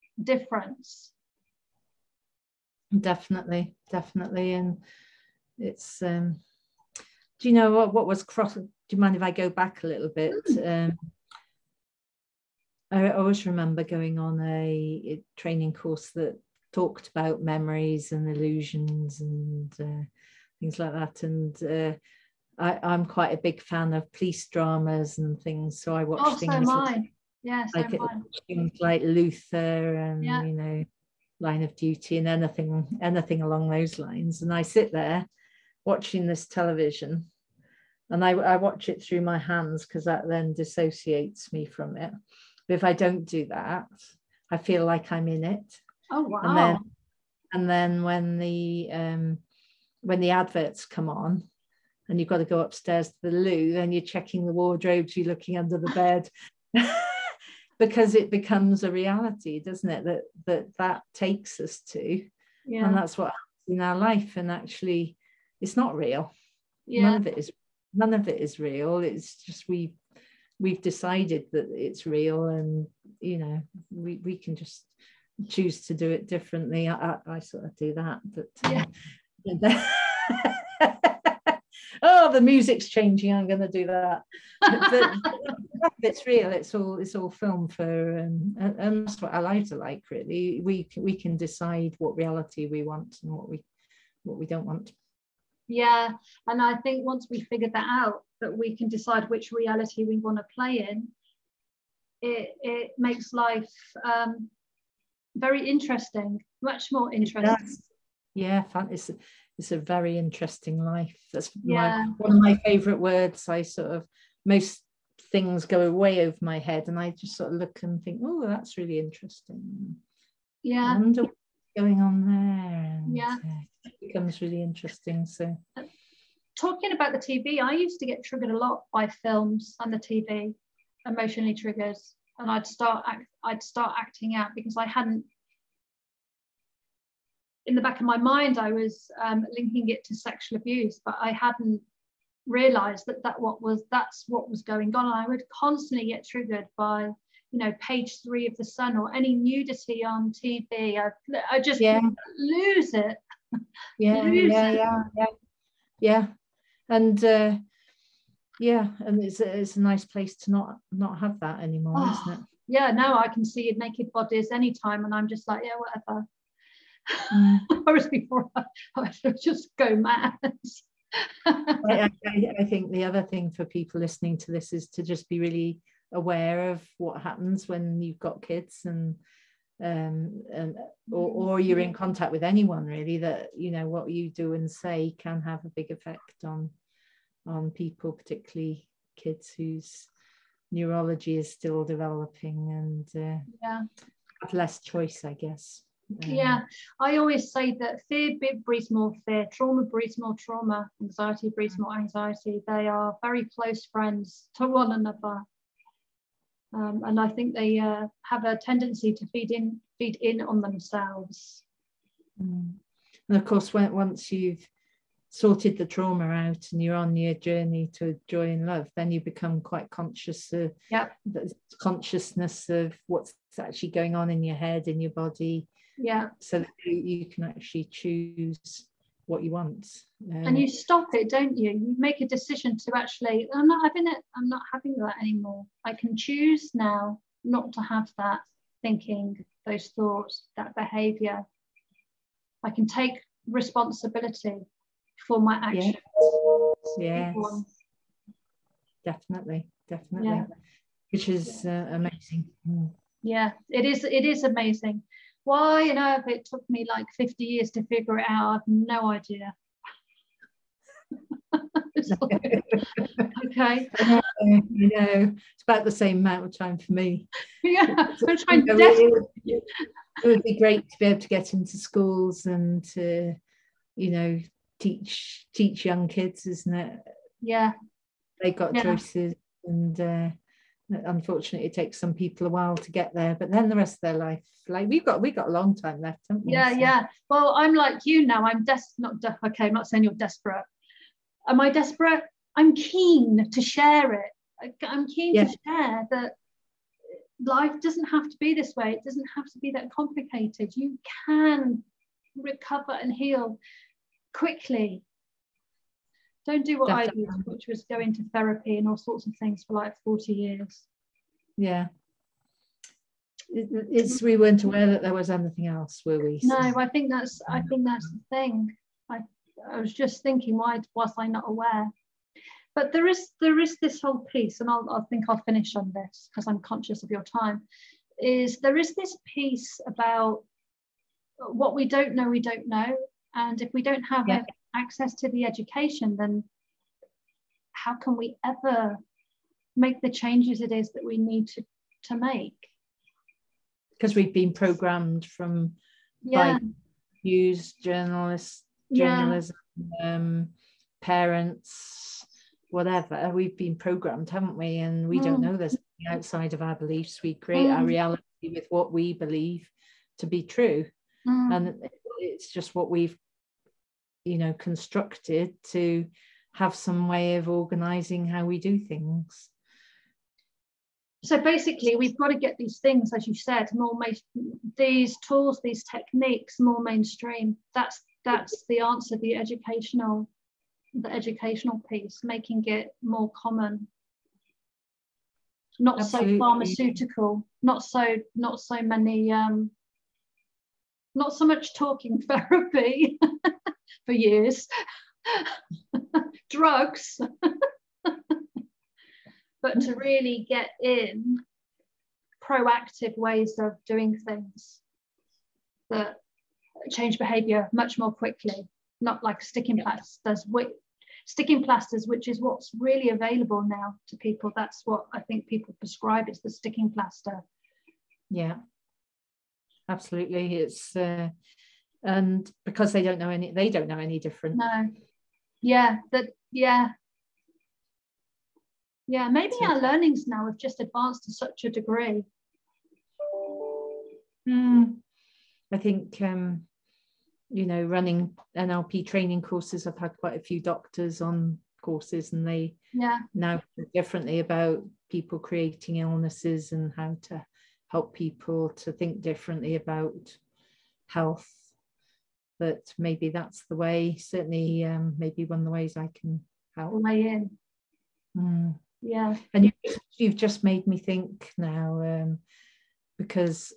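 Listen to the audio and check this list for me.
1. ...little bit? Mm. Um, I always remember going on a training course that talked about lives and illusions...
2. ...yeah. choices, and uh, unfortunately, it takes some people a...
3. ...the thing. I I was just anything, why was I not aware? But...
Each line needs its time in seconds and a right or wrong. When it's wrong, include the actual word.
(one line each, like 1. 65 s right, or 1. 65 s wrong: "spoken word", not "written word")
1. 9 s wrong: "memories", not "lives"
2. 278 s right
3. 318 s wrong: "thinking", not "anything".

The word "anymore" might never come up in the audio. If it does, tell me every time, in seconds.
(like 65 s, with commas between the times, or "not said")
161 s, 235 s.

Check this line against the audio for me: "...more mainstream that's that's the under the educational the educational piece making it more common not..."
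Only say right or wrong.
wrong.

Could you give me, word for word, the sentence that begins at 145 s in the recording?
And I would constantly get triggered by you know page three of the Sun or any nudity on TV.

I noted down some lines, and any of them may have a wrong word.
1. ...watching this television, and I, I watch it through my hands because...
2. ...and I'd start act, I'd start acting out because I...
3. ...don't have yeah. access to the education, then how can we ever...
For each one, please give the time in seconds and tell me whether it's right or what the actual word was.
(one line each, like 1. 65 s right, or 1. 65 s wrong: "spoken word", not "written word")
1. 35 s right
2. 132 s right
3. 333 s right.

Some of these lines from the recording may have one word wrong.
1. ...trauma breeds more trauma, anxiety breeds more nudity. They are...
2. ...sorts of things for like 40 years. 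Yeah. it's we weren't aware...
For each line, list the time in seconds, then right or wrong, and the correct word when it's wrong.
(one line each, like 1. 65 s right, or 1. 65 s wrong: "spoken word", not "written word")
1. 199 s wrong: "anxiety", not "nudity"
2. 308 s right.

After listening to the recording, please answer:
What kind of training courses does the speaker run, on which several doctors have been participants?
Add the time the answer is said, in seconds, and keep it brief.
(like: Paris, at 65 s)
NLP, at 438 s.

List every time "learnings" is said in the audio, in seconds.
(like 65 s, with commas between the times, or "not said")
429 s.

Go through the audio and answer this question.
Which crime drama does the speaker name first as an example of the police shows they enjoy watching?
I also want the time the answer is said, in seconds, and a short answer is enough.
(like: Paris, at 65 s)
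Luther, at 29 s.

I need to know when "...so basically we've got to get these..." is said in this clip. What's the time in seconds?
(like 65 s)
371 s.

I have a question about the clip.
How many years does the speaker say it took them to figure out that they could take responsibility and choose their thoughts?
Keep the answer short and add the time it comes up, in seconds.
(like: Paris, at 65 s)
50, at 257 s.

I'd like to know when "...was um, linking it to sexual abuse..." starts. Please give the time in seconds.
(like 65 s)
138 s.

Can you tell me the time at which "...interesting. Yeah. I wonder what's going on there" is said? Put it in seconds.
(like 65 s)
118 s.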